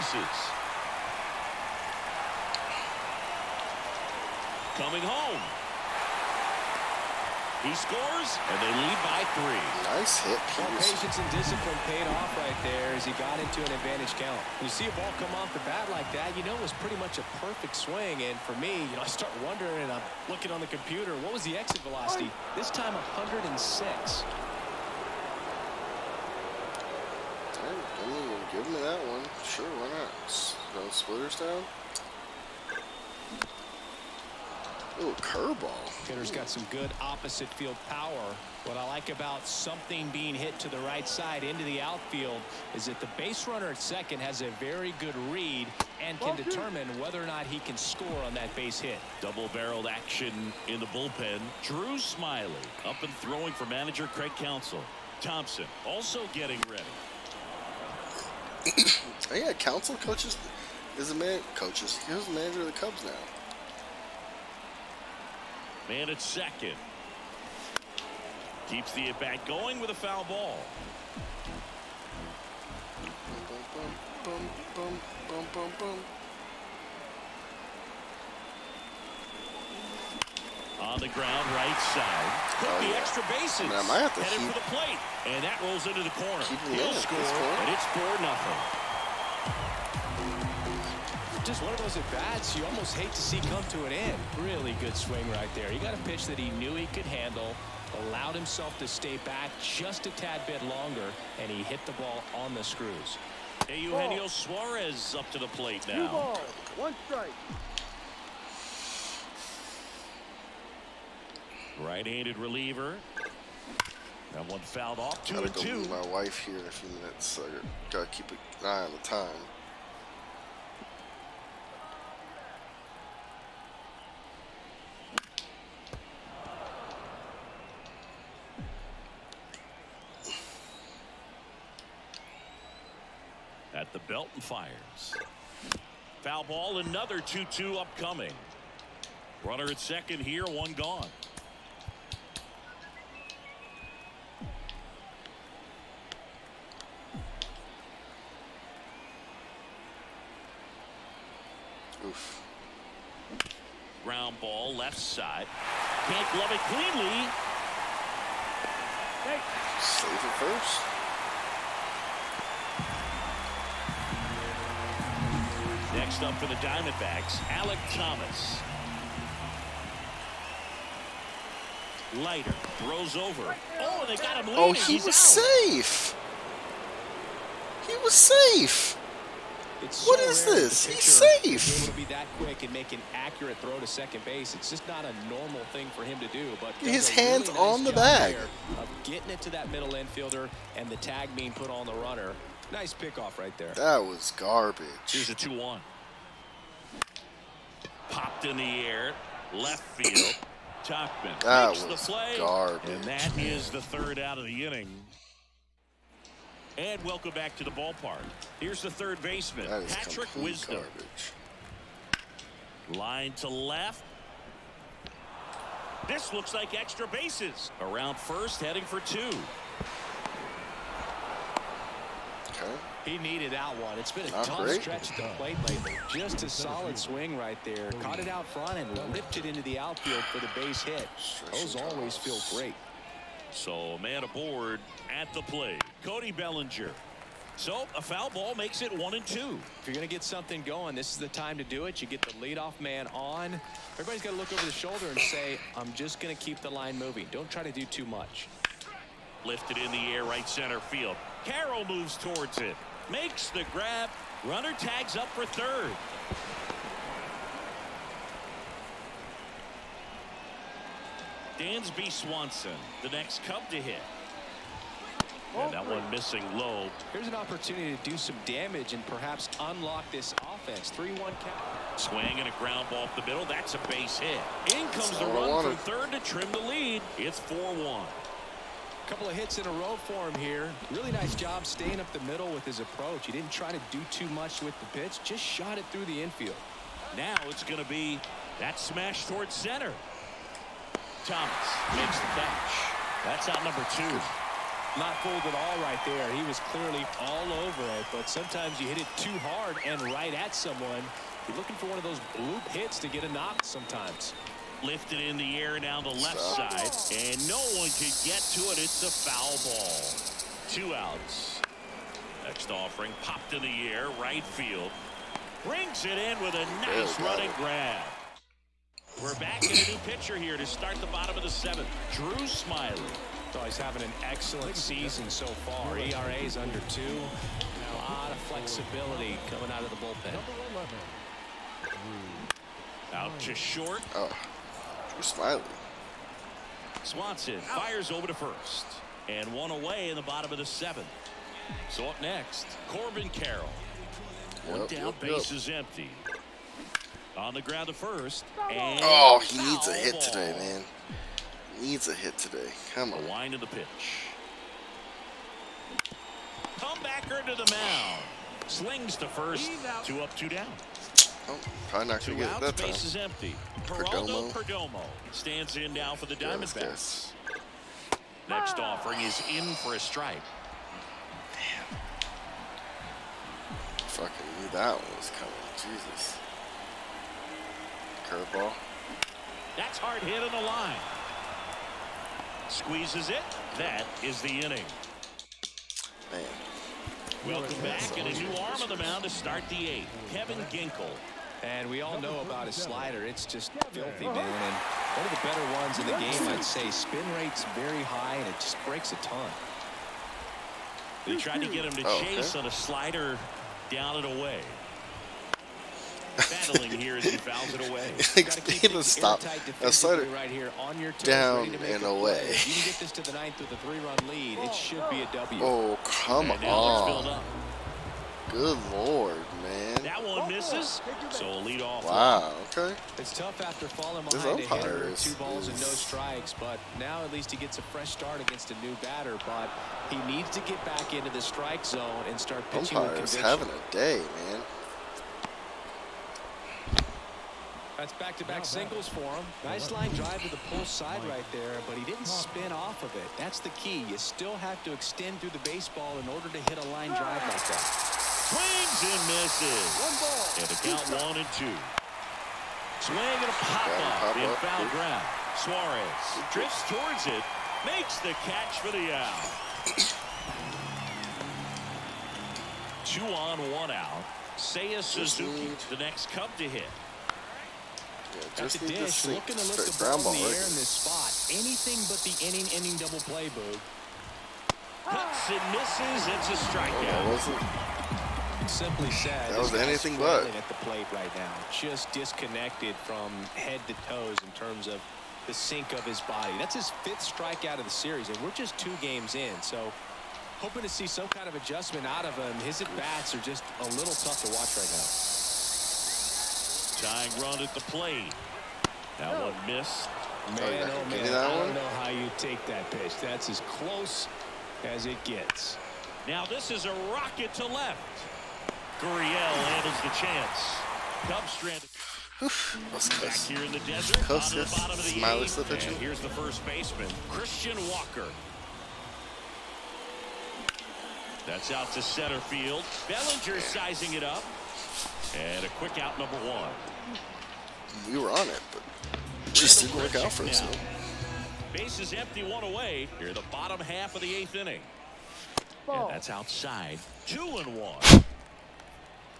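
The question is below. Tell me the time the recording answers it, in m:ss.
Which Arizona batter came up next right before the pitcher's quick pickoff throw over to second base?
2:47.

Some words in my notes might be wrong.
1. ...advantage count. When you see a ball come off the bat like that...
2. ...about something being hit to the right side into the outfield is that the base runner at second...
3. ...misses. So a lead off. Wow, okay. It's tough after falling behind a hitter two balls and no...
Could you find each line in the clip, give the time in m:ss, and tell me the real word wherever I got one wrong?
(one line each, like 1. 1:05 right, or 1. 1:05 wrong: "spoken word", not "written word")
1. 0:13 right
2. 0:39 right
3. 7:00 right.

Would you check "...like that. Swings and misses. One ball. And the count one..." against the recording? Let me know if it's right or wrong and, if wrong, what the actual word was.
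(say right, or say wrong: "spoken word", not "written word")
right.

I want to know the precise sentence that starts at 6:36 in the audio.
Spin rate's very high, and it just breaks a ton.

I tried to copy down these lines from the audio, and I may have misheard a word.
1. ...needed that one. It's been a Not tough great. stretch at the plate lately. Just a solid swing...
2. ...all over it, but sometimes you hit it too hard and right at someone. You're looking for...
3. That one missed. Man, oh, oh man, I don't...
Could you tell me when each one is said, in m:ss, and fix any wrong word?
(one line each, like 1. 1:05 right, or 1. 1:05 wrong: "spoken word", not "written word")
1. 3:43 right
2. 4:57 right
3. 8:19 right.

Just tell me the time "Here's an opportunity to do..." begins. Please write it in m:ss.
4:27.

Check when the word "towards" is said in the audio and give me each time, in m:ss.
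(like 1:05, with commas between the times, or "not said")
4:12, 4:49, 7:36.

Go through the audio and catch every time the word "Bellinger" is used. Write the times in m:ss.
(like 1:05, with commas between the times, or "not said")
3:56, 8:43.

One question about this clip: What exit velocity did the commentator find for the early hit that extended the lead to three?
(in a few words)
106.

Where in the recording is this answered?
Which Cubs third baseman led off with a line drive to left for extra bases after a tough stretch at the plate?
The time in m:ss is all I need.
3:29.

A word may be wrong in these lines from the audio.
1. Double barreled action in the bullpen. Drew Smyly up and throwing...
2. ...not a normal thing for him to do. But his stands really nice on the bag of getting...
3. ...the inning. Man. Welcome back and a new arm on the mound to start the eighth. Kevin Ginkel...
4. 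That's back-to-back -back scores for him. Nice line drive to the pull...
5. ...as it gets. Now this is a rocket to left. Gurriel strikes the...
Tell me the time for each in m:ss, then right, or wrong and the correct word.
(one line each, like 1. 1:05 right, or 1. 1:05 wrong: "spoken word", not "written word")
1. 0:49 right
2. 3:04 wrong: "hands", not "stands"
3. 6:24 right
4. 7:17 wrong: "singles", not "scores"
5. 8:24 wrong: "handles", not "strikes".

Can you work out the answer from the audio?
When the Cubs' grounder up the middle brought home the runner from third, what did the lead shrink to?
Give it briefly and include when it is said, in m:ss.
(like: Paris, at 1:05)
4-1, at 4:37.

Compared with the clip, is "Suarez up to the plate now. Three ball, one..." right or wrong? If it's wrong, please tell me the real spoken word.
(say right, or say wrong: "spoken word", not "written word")
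wrong: "Two", not "Three".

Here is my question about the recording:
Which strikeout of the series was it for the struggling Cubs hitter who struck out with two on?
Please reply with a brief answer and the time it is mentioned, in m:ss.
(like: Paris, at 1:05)
fifth, at 8:07.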